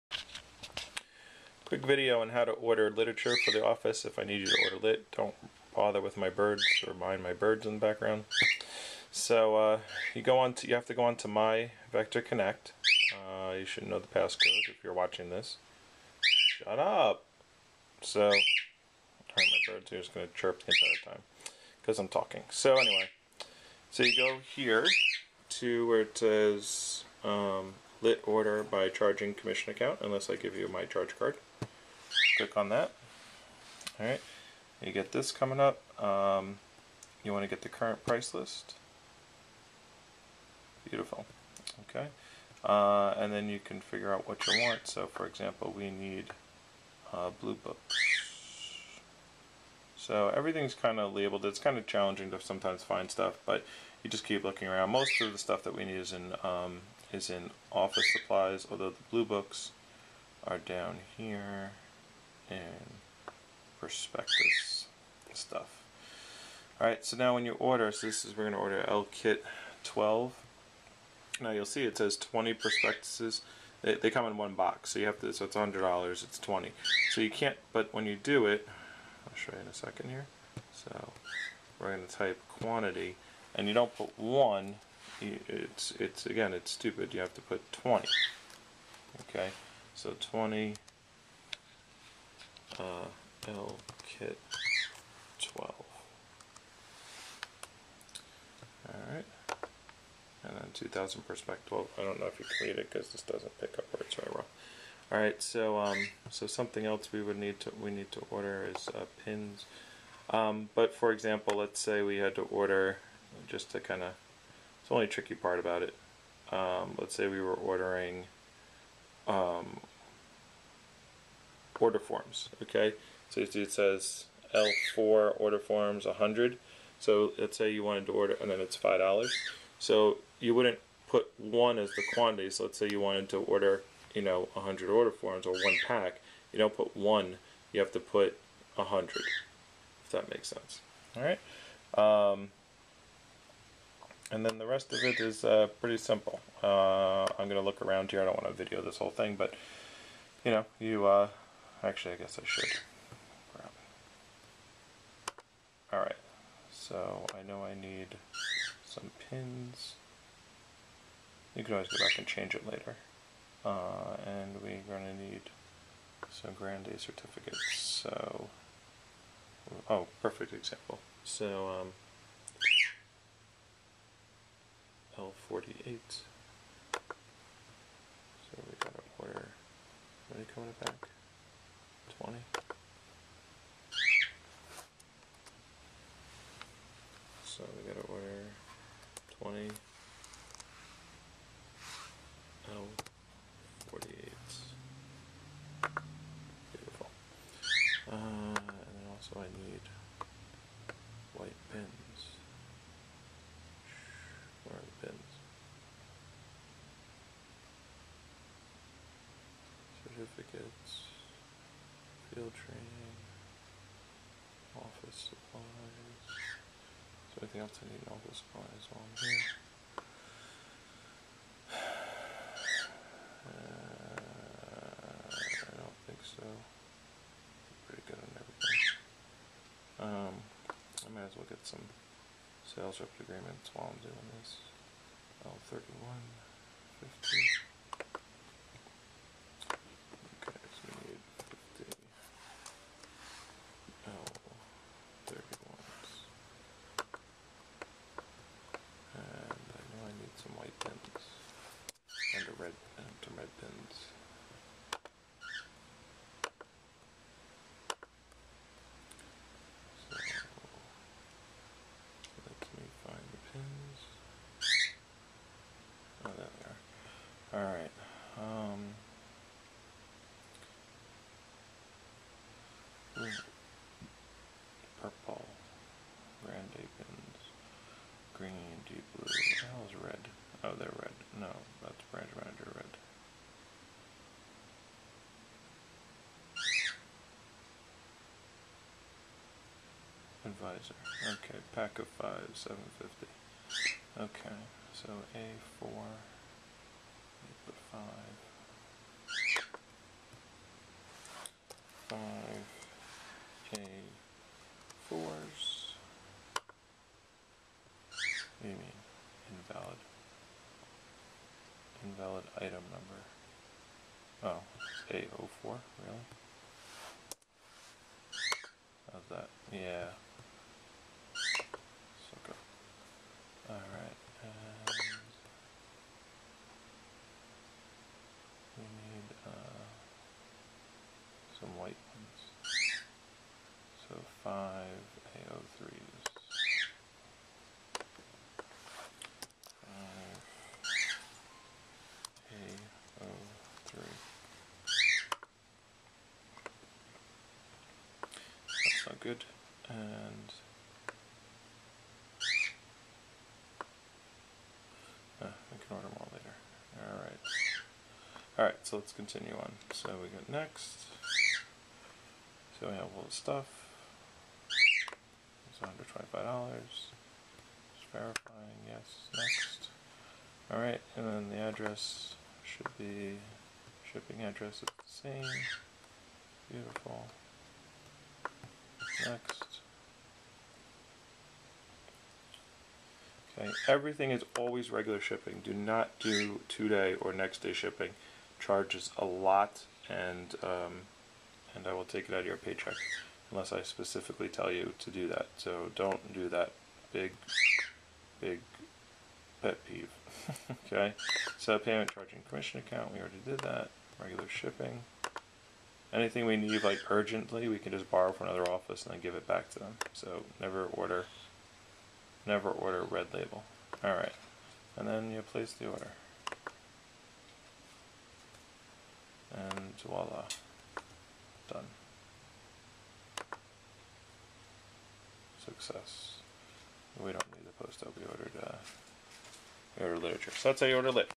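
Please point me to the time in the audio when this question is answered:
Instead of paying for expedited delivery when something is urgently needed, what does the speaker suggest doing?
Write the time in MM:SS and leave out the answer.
06:48.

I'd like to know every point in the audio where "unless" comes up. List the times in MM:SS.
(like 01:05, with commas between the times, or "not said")
00:30, 06:33.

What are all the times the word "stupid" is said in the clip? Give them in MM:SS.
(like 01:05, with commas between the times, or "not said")
01:26.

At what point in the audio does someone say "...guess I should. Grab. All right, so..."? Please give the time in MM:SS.
02:32.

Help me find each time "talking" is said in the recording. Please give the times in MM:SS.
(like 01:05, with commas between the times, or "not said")
00:22.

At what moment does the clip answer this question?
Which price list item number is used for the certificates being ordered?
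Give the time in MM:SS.
02:55.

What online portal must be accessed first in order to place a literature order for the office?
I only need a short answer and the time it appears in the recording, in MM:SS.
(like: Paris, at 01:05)
My Vector Connect, at 00:11.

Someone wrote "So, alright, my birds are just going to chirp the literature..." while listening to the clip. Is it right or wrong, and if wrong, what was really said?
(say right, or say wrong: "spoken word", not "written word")
wrong: "entire", not "literature".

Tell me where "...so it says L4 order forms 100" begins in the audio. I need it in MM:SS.
02:03.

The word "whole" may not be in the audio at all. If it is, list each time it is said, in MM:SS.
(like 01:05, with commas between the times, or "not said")
02:28.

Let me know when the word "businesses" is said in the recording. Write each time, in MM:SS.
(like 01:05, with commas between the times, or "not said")
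not said.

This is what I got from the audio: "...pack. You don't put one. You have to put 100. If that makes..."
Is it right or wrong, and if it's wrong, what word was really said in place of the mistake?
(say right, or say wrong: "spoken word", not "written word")
right.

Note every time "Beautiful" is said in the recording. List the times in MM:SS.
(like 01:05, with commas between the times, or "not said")
00:40, 06:16.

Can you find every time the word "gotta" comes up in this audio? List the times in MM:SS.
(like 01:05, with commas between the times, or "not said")
02:58, 03:07.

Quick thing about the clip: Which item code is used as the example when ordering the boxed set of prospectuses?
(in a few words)
L Kit 12.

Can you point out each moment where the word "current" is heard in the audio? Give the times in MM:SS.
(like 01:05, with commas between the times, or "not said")
00:37.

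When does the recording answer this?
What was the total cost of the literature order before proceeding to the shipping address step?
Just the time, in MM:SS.
06:05.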